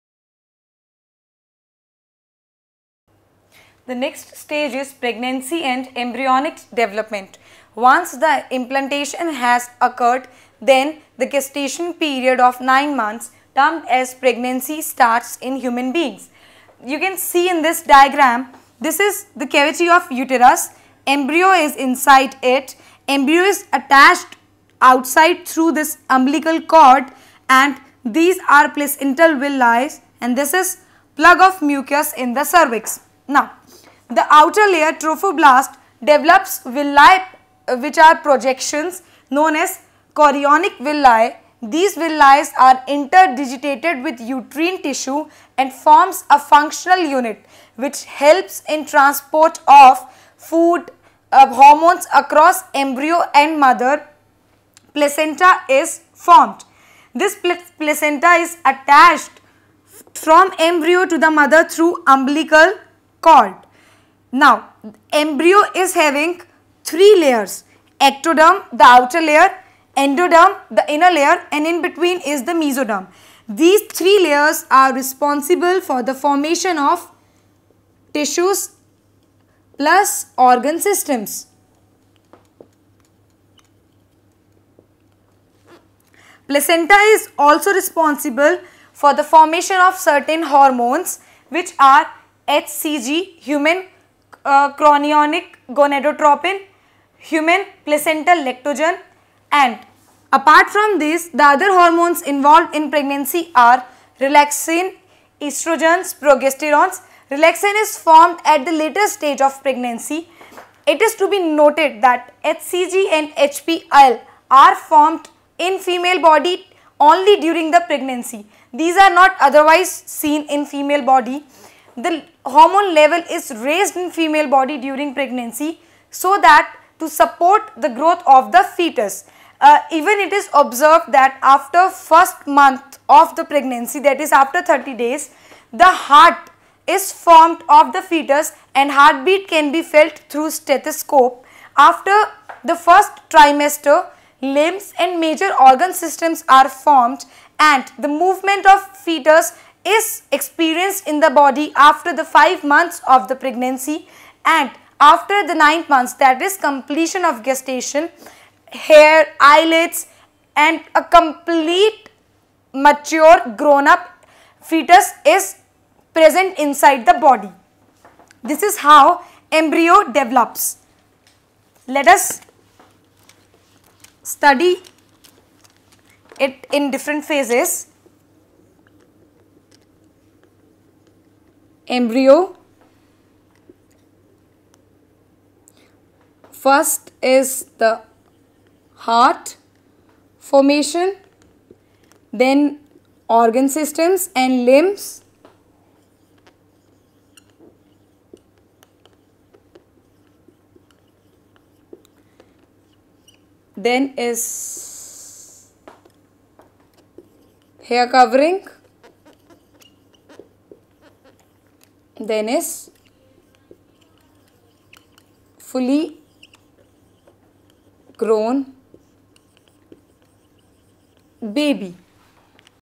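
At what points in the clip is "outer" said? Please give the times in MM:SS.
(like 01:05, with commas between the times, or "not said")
00:34, 01:08.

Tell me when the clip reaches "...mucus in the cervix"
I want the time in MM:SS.
00:31.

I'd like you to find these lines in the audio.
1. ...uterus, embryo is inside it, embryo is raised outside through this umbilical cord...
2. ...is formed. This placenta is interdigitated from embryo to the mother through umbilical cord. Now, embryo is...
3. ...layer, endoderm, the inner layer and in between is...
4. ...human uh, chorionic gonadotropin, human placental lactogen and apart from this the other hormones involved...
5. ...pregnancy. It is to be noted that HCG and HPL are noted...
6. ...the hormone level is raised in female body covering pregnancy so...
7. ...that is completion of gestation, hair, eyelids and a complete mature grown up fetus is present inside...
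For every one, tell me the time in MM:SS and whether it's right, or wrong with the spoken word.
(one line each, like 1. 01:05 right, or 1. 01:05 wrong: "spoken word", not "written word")
1. 00:20 wrong: "attached", not "raised"
2. 00:55 wrong: "attached", not "interdigitated"
3. 01:09 right
4. 01:33 right
5. 01:49 wrong: "formed", not "noted"
6. 02:01 wrong: "during", not "covering"
7. 02:36 right.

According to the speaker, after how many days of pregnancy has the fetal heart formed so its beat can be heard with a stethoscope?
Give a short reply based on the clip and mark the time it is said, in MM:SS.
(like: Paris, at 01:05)
30, at 02:14.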